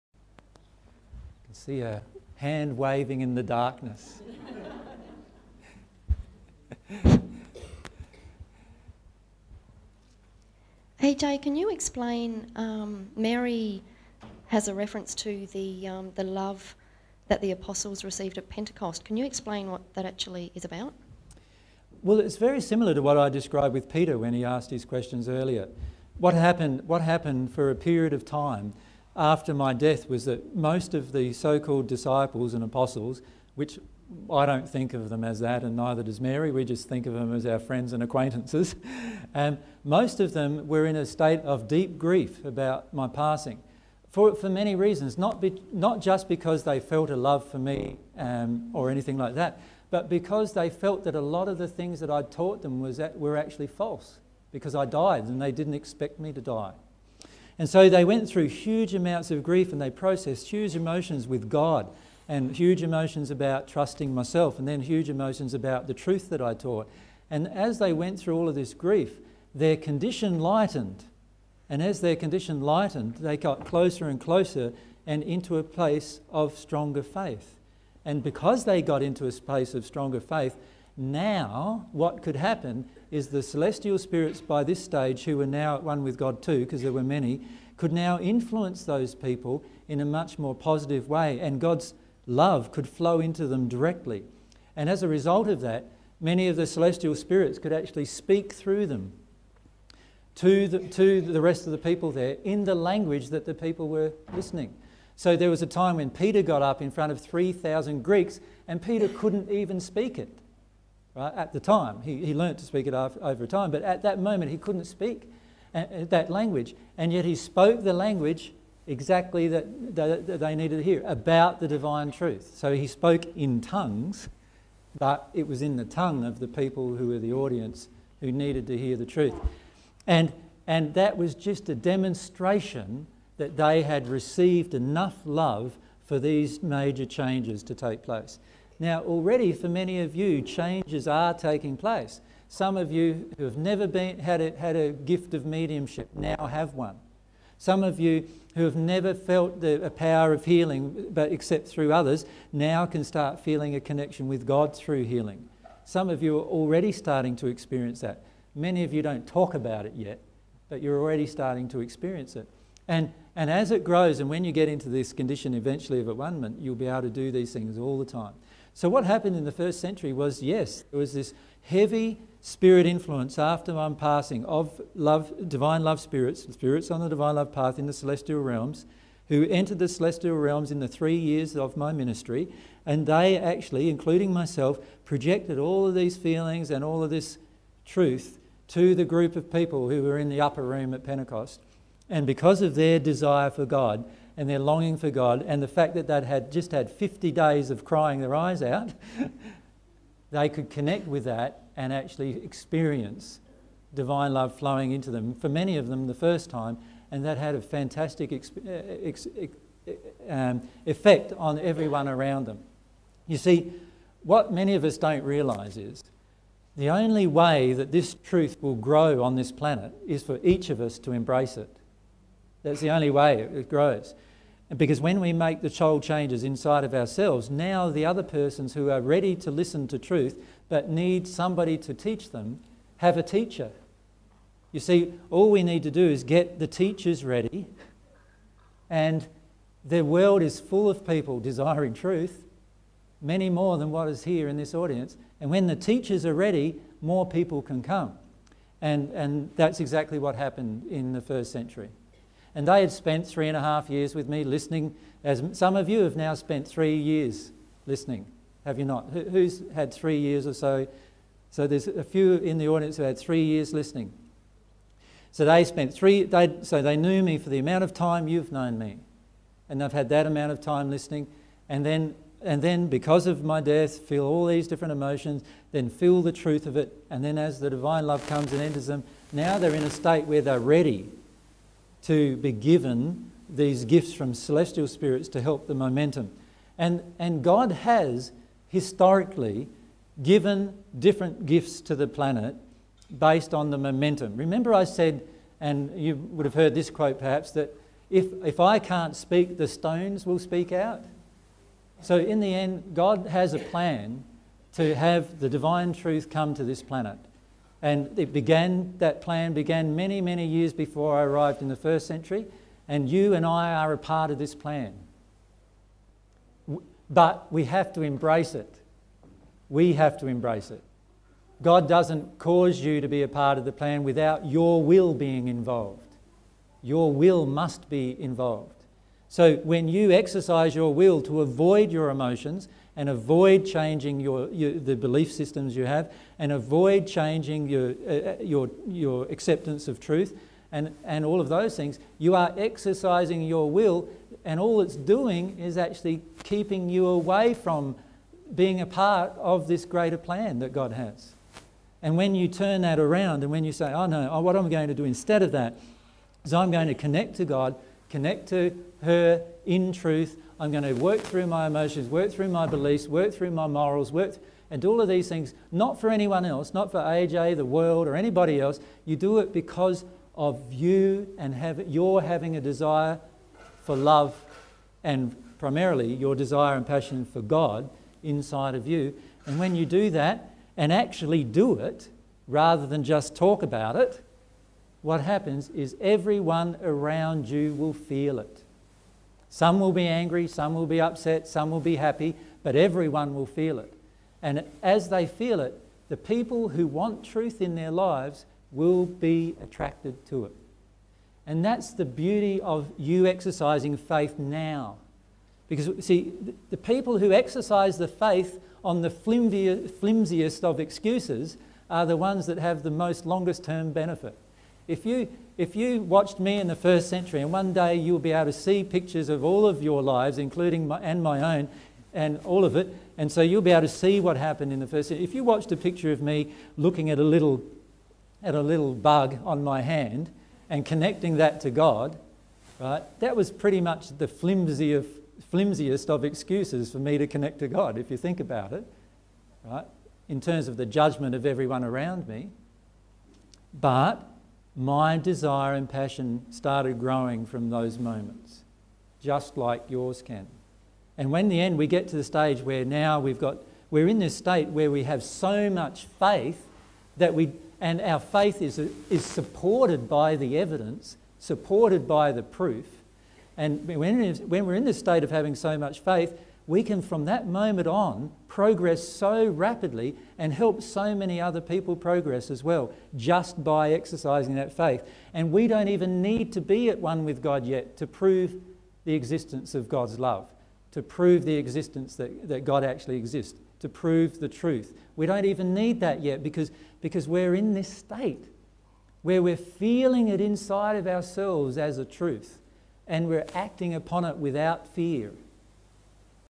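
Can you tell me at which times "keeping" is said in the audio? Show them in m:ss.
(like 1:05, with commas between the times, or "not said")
5:46.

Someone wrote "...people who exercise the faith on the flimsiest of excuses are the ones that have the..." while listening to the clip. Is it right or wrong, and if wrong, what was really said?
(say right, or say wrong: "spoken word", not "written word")
right.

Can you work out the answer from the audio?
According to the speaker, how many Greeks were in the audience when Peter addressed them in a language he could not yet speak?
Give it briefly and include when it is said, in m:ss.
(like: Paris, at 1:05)
3,000, at 1:47.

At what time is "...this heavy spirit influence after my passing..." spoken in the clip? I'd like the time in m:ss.
2:51.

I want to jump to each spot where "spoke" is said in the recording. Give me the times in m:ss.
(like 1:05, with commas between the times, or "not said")
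1:57, 2:02.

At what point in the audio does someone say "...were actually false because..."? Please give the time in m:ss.
0:53.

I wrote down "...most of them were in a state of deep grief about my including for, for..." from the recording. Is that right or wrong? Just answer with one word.
wrong.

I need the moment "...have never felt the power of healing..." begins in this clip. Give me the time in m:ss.
2:28.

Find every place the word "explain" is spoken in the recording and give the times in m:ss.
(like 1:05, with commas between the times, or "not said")
0:11, 0:19.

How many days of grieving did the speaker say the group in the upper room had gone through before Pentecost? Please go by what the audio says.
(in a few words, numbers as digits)
50.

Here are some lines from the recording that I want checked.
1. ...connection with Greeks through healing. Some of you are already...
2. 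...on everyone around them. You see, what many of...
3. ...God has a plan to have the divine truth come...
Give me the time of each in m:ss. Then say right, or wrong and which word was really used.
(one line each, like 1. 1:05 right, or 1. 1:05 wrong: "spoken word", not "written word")
1. 2:33 wrong: "God", not "Greeks"
2. 3:31 right
3. 5:02 right.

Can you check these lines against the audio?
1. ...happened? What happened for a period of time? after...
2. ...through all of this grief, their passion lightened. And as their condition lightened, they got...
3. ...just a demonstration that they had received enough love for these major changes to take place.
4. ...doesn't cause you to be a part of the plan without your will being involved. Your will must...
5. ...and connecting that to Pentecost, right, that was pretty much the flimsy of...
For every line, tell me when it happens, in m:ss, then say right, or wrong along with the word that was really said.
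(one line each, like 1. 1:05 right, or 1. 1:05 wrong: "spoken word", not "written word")
1. 0:26 right
2. 1:08 wrong: "condition", not "passion"
3. 2:11 right
4. 5:21 right
5. 7:10 wrong: "God", not "Pentecost".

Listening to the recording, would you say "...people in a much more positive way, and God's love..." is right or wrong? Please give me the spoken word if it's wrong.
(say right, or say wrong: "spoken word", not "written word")
right.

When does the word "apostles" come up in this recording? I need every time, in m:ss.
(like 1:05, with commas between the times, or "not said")
0:17, 0:32.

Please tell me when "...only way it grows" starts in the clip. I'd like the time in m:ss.
3:42.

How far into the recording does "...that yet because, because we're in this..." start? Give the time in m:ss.
8:05.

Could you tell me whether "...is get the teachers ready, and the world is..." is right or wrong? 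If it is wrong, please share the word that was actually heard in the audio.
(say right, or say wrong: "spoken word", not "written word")
right.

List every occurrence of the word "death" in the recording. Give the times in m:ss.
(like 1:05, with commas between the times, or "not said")
0:29, 4:33.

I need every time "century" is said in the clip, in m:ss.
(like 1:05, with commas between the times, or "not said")
2:49, 4:11, 5:12, 6:57, 7:05.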